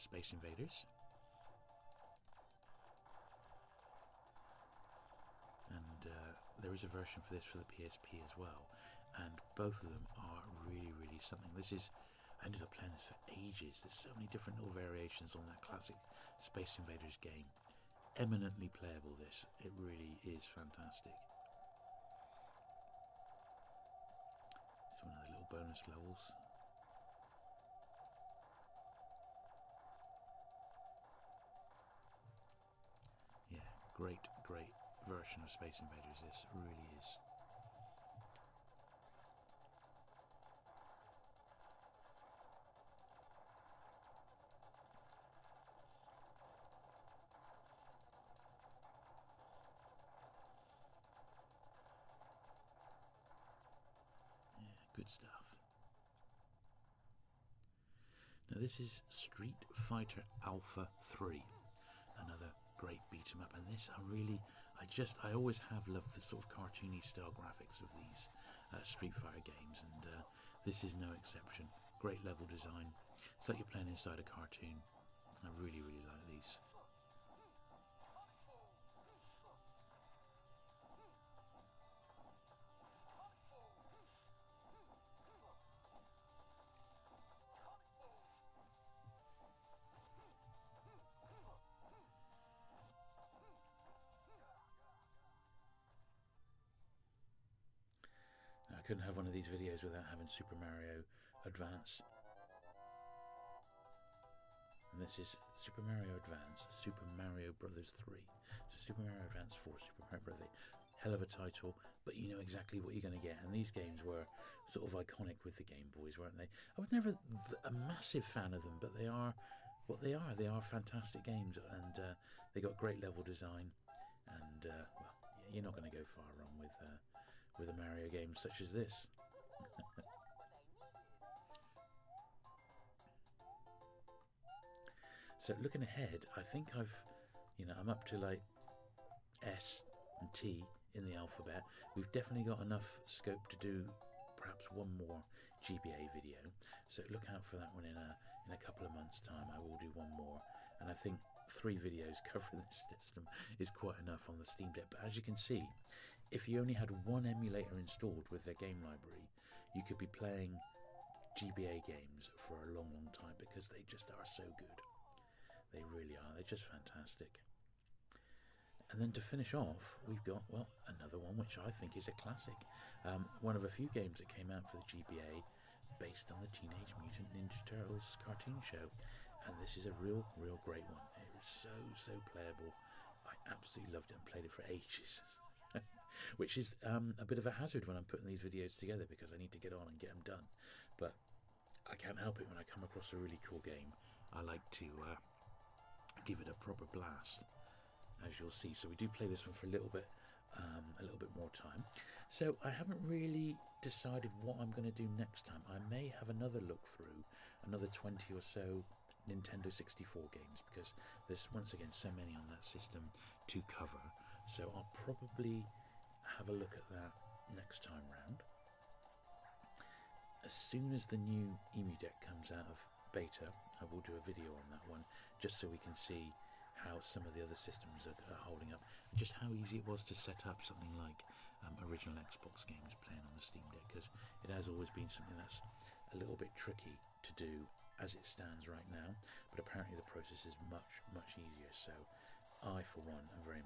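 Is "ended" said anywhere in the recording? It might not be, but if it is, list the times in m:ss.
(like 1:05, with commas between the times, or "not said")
0:12.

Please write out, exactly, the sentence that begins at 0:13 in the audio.
There's so many different little variations on that classic Space Invaders game.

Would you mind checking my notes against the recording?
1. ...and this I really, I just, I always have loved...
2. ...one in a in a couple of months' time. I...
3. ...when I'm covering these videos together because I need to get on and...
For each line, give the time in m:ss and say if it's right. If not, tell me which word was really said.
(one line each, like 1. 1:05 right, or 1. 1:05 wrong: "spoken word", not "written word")
1. 1:03 right
2. 2:27 right
3. 3:07 wrong: "putting", not "covering".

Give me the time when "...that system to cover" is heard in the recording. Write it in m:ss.
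3:32.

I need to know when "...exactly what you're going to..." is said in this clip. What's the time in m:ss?
1:52.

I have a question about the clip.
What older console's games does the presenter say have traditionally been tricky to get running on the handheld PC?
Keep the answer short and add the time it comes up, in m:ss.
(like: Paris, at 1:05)
original Xbox, at 3:51.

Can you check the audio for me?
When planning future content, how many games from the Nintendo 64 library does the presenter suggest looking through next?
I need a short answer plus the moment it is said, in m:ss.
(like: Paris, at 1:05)
20, at 3:27.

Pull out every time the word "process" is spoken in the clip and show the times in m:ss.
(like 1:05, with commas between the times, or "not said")
4:00.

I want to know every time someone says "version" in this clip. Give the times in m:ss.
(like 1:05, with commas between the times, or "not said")
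0:06, 0:35.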